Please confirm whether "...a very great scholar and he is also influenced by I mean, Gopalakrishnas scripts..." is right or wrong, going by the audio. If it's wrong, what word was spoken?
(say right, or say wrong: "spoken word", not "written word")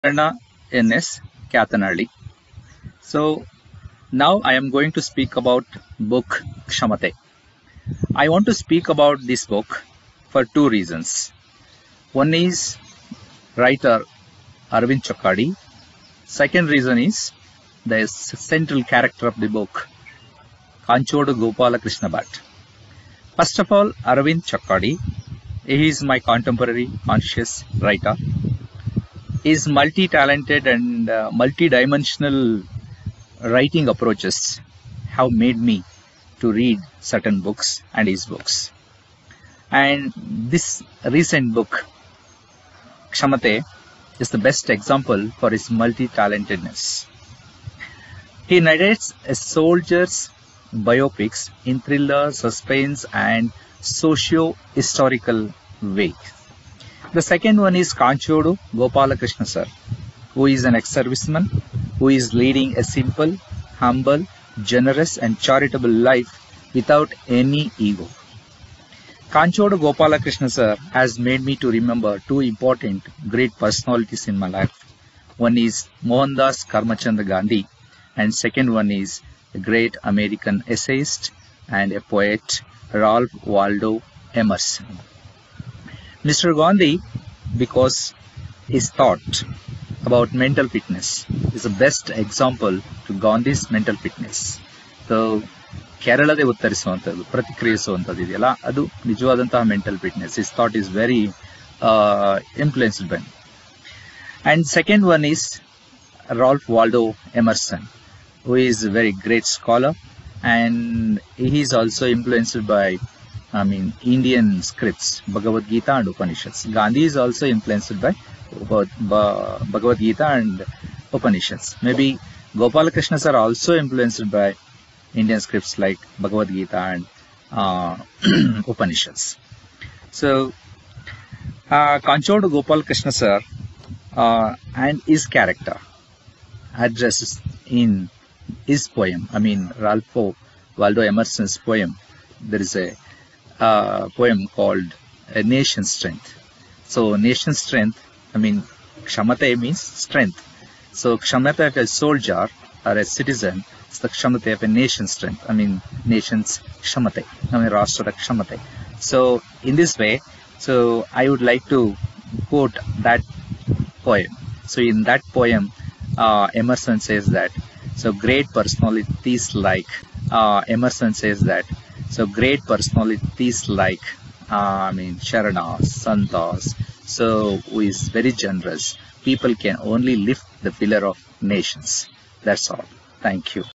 wrong: "Indian", not "Gopalakrishnas".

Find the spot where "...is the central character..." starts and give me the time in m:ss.
0:16.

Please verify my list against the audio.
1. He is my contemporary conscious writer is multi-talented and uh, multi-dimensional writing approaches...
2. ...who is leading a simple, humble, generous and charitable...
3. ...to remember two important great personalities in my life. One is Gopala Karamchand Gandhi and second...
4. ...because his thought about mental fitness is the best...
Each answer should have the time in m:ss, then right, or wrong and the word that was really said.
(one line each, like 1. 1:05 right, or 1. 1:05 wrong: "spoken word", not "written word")
1. 0:25 right
2. 1:01 right
3. 1:11 wrong: "Mohandas", not "Gopala"
4. 1:27 right.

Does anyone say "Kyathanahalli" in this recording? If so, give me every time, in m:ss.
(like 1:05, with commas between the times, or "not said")
0:01.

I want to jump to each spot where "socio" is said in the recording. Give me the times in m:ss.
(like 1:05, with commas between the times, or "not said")
0:53.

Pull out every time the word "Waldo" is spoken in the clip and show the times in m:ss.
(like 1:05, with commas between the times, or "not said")
1:23, 1:46, 2:20.